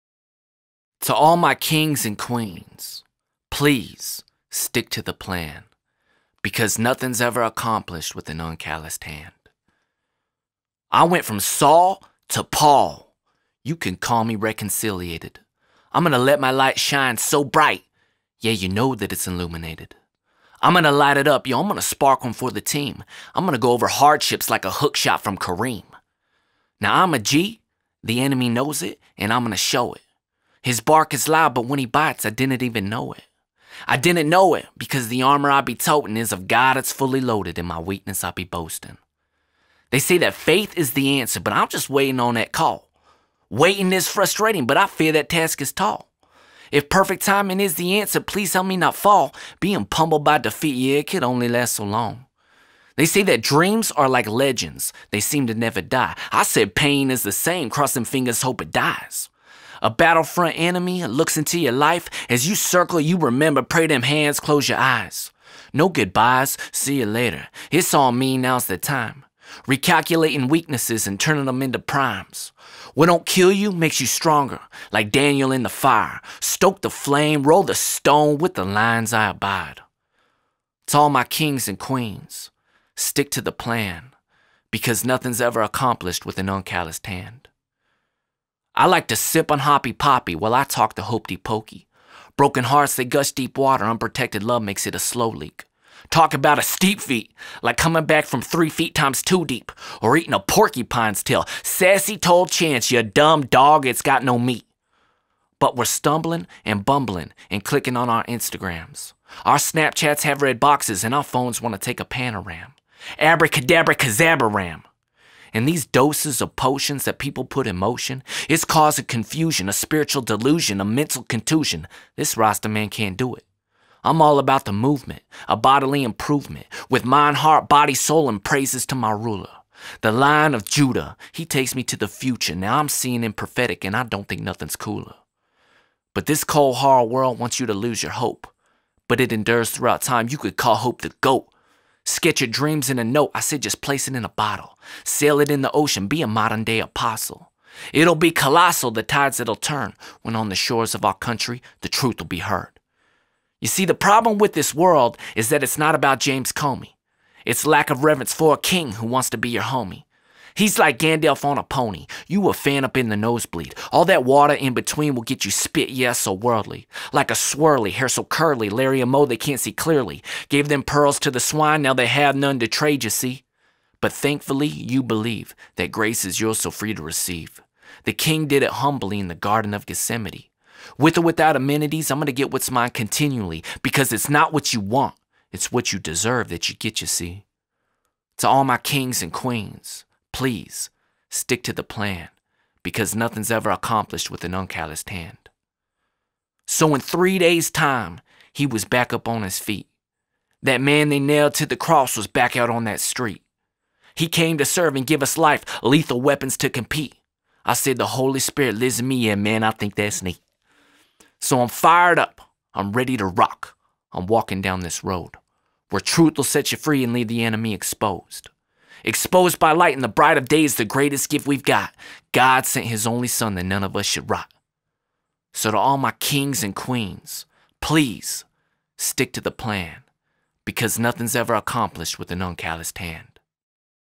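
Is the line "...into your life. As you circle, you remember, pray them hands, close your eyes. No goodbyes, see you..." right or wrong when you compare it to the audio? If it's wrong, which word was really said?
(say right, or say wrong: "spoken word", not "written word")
right.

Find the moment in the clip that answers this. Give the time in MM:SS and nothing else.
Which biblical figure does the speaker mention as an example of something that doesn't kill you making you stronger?
01:15.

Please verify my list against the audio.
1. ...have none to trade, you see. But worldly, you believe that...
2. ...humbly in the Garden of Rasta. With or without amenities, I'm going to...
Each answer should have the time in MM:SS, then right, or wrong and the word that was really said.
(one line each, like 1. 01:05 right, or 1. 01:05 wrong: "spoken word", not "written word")
1. 02:52 wrong: "thankfully", not "worldly"
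2. 02:58 wrong: "Gethsemane", not "Rasta".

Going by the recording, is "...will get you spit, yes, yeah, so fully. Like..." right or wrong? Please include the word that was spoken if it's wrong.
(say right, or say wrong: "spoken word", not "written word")
wrong: "worldly", not "fully".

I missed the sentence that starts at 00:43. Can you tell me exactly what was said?
Waiting is frustrating, but I fear that task is tall.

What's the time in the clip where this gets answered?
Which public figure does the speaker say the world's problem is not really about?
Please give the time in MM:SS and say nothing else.
02:36.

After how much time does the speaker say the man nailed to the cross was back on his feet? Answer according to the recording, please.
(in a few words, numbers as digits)
3 days.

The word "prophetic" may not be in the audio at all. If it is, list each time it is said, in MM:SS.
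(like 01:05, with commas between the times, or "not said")
02:13.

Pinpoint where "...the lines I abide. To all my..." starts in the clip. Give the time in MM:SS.
01:18.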